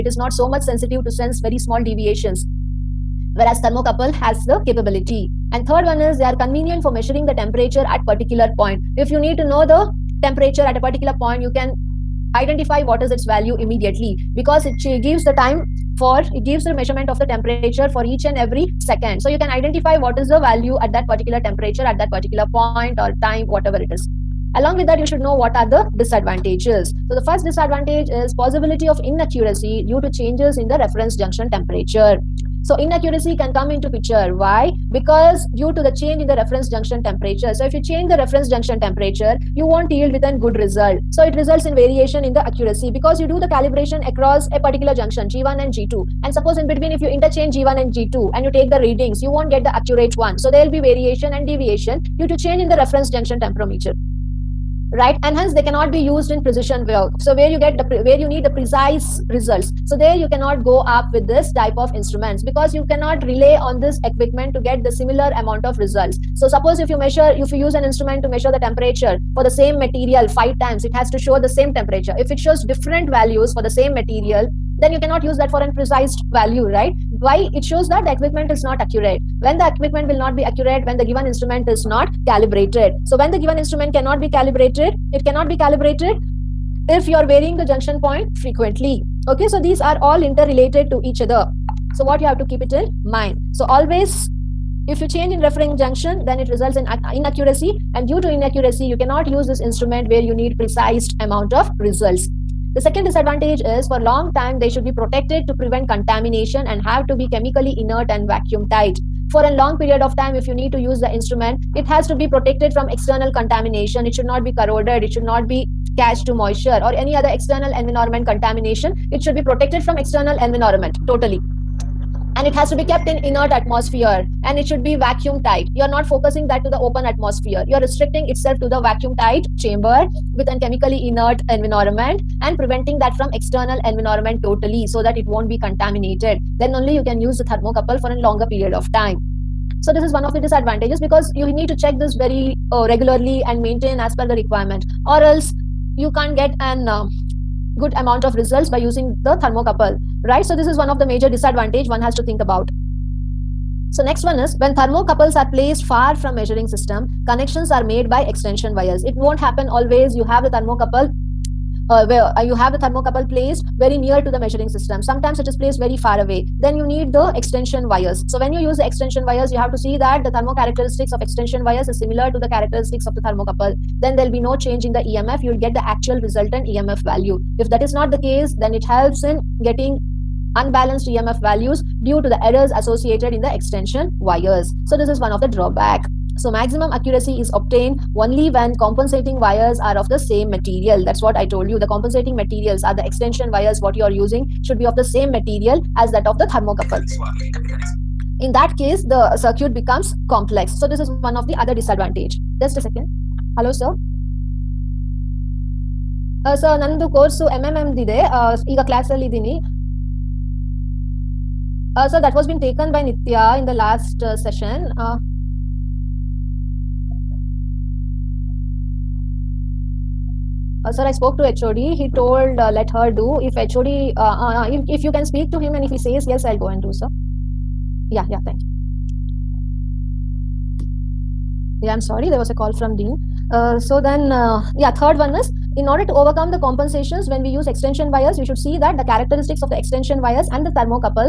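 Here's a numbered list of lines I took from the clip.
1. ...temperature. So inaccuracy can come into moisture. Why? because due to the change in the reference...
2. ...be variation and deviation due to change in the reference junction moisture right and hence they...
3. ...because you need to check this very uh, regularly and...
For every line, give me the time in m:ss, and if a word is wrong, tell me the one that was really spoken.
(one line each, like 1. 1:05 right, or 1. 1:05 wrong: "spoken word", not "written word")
1. 0:31 wrong: "picture", not "moisture"
2. 0:50 wrong: "temperature", not "moisture"
3. 2:20 right.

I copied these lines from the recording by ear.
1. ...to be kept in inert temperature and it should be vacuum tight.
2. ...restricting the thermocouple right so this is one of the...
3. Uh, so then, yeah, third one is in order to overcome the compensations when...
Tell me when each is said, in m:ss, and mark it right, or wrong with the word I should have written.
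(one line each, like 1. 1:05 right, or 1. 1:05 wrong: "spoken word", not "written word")
1. 2:02 wrong: "atmosphere", not "temperature"
2. 2:28 wrong: "using", not "restricting"
3. 3:53 right.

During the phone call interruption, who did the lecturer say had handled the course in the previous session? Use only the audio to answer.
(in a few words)
Nitya.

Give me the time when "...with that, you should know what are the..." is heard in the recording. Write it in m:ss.
0:24.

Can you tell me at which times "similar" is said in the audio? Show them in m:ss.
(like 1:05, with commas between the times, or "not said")
1:04, 2:51.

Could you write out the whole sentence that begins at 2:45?
Sometimes it is placed very far away.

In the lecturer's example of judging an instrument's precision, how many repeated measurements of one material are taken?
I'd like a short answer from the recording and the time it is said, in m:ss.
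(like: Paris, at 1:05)
5, at 1:10.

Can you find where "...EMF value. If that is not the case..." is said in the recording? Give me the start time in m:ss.
2:56.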